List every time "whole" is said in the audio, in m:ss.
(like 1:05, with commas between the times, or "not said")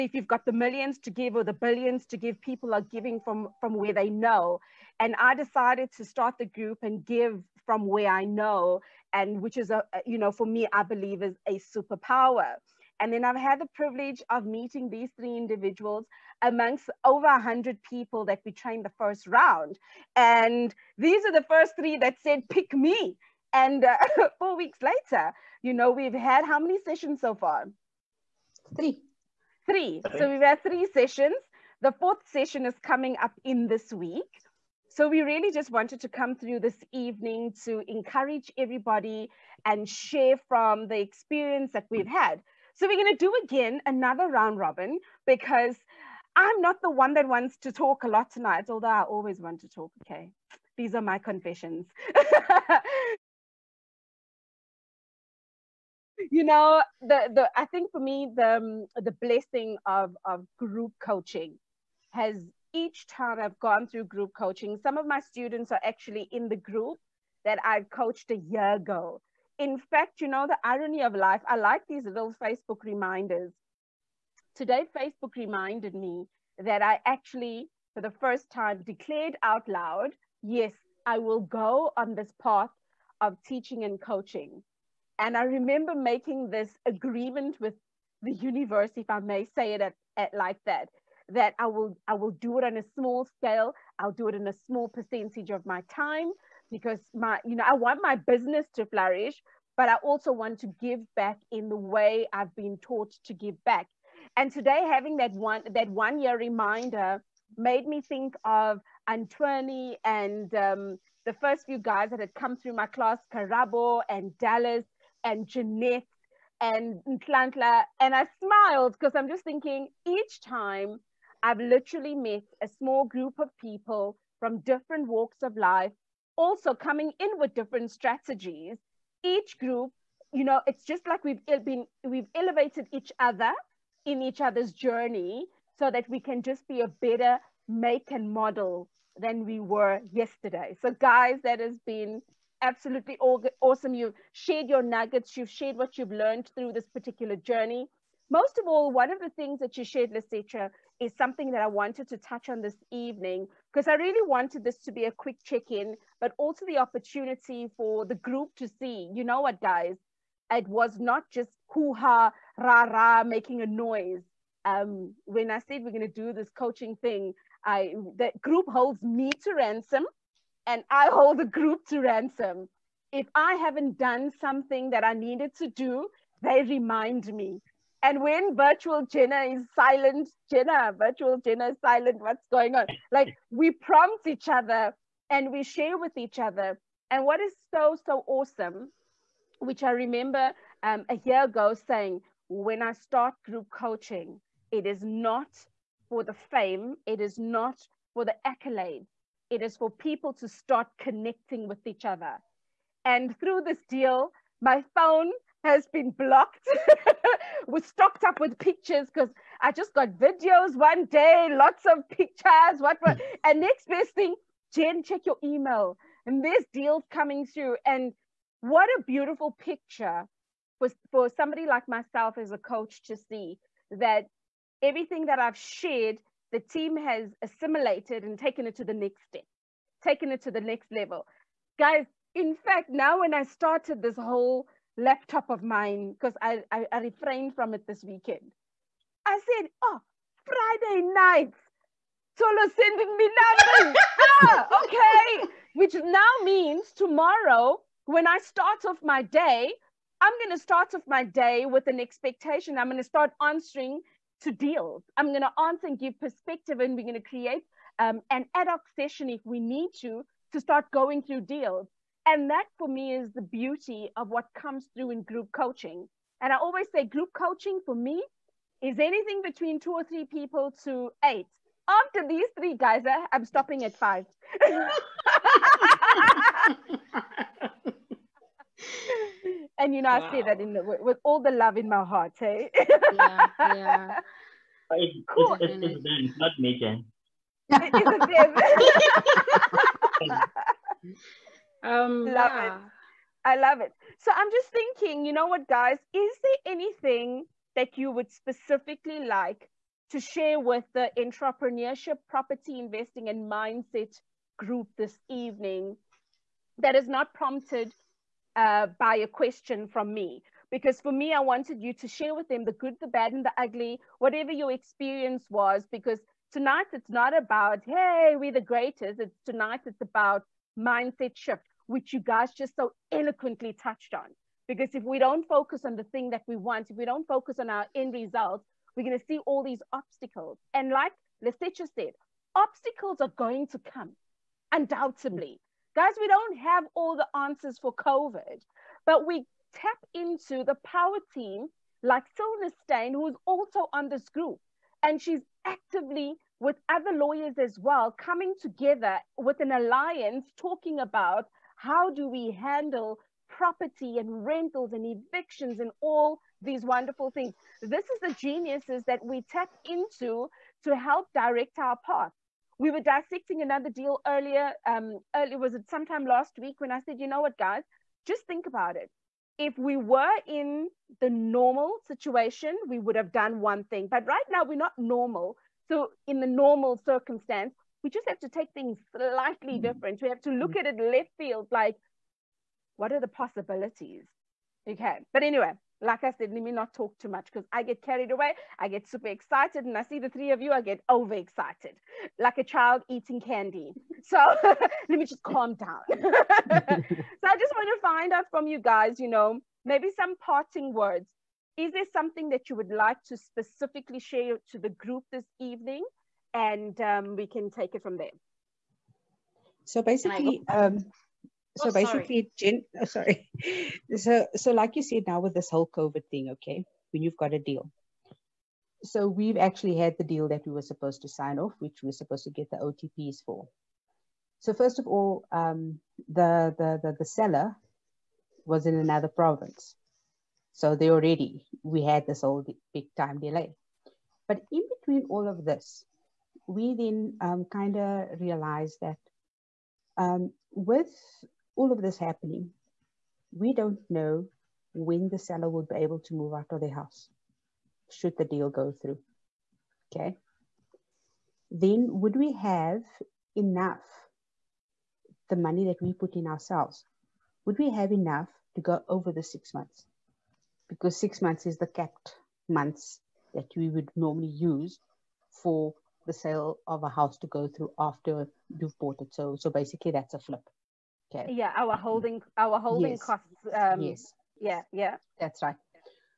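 3:54, 6:55, 7:12.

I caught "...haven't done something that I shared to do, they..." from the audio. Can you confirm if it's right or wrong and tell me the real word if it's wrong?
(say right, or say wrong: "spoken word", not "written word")
wrong: "needed", not "shared".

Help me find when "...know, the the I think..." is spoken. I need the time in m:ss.
0:56.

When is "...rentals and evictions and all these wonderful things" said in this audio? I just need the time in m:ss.
5:54.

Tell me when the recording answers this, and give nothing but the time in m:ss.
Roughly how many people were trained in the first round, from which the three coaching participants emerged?
0:17.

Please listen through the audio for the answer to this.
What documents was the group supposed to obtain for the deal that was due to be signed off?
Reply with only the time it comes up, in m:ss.
7:02.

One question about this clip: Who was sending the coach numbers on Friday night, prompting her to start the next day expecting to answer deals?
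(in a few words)
Tsholo.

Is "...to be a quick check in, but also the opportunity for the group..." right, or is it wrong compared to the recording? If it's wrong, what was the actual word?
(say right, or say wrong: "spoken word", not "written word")
right.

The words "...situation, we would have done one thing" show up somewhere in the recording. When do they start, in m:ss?
6:12.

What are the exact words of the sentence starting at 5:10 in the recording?
Because for me, I wanted you to share with them the good, the bad, and the ugly, whatever your experience was.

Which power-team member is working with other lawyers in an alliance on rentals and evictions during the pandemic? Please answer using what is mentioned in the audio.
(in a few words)
Silnerstein.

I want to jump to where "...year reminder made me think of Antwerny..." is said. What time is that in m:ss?
1:46.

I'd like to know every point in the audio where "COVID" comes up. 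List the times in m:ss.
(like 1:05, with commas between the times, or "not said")
5:37, 6:55.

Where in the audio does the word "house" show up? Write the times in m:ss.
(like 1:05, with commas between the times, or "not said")
7:26, 7:47.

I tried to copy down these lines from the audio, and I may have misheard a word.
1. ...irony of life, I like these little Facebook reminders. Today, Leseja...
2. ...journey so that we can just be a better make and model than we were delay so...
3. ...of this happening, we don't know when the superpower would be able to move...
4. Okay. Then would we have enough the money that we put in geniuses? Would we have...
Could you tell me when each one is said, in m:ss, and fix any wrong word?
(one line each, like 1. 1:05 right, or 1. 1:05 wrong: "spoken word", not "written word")
1. 1:10 wrong: "Facebook", not "Leseja"
2. 2:14 wrong: "yesterday", not "delay"
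3. 7:21 wrong: "seller", not "superpower"
4. 7:30 wrong: "ourselves", not "geniuses".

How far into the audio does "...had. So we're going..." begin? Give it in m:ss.
0:42.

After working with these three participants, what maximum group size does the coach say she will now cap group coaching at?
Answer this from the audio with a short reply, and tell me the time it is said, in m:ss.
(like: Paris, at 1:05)
5, at 4:33.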